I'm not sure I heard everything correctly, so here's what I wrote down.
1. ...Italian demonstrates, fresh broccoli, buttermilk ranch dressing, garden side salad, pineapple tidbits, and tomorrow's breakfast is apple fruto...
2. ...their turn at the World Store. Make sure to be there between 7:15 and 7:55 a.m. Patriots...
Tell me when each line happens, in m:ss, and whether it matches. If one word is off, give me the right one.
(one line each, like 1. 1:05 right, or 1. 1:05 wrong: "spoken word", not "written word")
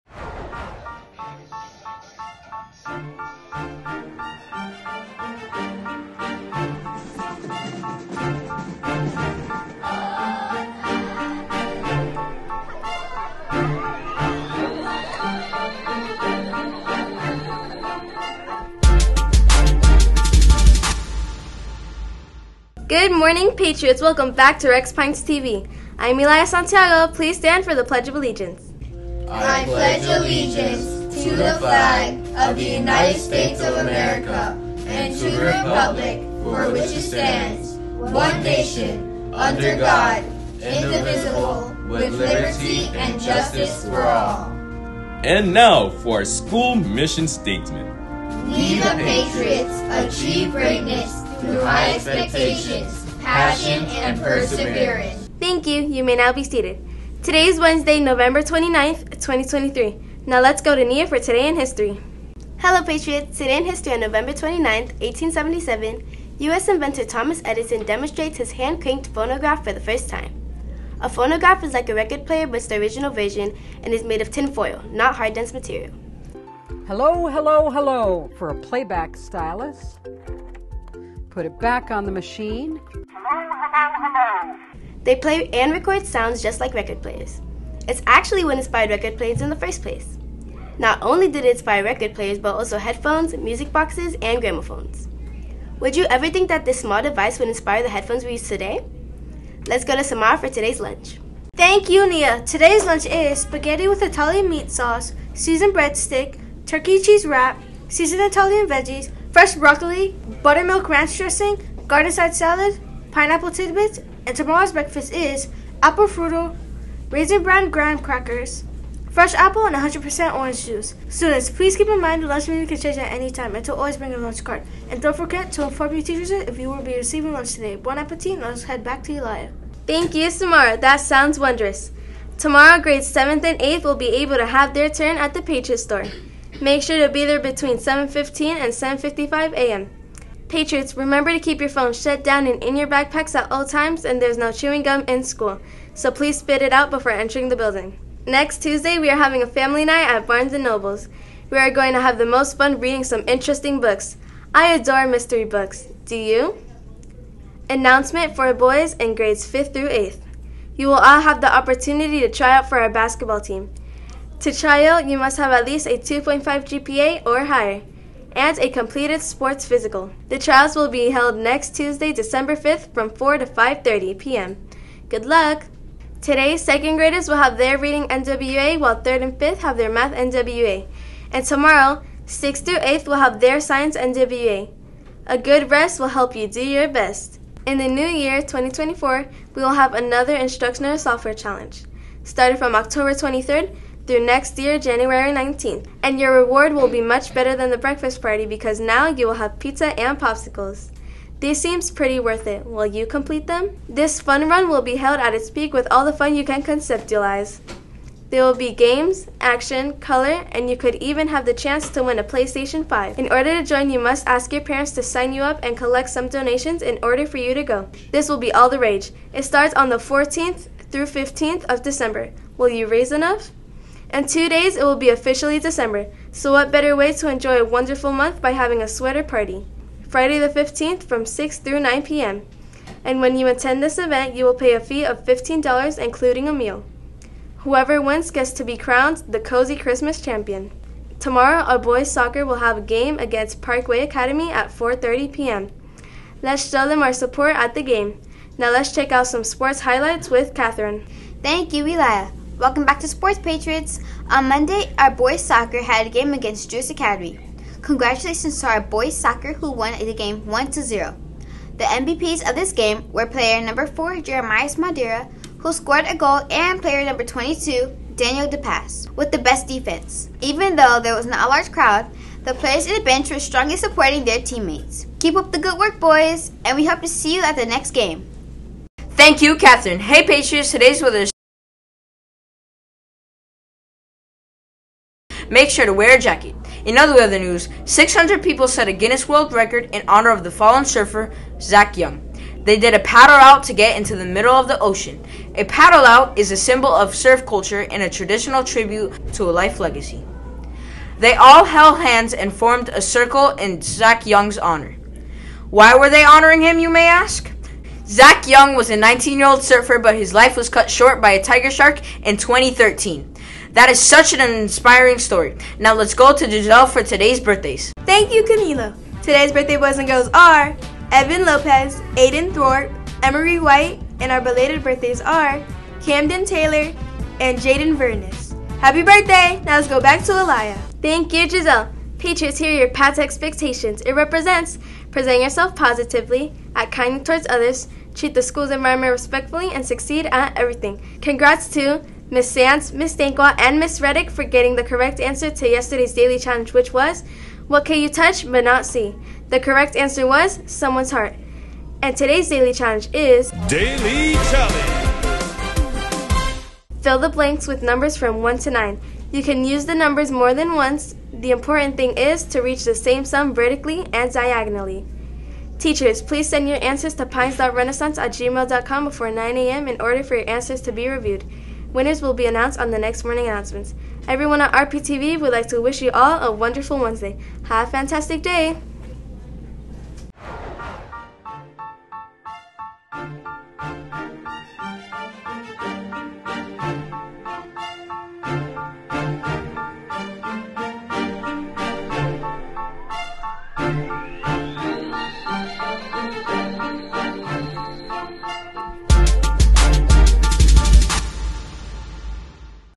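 1. 1:48 wrong: "veggies", not "demonstrates"
2. 2:14 wrong: "Patriot", not "World".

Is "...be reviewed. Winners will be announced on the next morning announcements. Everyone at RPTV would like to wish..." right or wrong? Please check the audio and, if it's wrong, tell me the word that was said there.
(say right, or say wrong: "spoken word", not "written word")
right.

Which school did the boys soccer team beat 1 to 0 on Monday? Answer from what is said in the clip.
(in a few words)
Juice Academy.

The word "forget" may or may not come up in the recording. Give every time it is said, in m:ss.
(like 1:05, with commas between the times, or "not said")
2:05.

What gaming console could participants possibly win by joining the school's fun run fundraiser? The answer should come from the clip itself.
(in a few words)
PlayStation 5.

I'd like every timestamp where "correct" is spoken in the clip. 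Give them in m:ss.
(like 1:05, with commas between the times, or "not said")
5:44, 5:49.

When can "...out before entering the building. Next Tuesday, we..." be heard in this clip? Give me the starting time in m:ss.
2:26.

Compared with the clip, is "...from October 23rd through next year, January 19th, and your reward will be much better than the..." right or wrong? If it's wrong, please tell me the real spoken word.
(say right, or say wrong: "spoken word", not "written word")
right.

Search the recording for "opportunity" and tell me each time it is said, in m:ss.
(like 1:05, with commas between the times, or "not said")
2:41.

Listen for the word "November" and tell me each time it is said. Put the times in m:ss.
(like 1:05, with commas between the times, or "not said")
0:57, 1:04.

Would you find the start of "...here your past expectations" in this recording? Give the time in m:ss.
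5:32.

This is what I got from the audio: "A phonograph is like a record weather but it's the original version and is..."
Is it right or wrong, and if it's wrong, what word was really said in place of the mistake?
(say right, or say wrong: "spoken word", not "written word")
wrong: "player", not "weather".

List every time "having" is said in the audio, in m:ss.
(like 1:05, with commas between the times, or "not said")
2:29, 3:48.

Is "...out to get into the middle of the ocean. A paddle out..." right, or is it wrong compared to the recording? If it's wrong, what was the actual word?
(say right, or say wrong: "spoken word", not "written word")
right.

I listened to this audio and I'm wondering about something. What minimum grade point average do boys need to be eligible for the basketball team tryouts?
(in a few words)
2.5.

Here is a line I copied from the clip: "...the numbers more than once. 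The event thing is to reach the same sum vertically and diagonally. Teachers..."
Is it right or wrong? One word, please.
wrong.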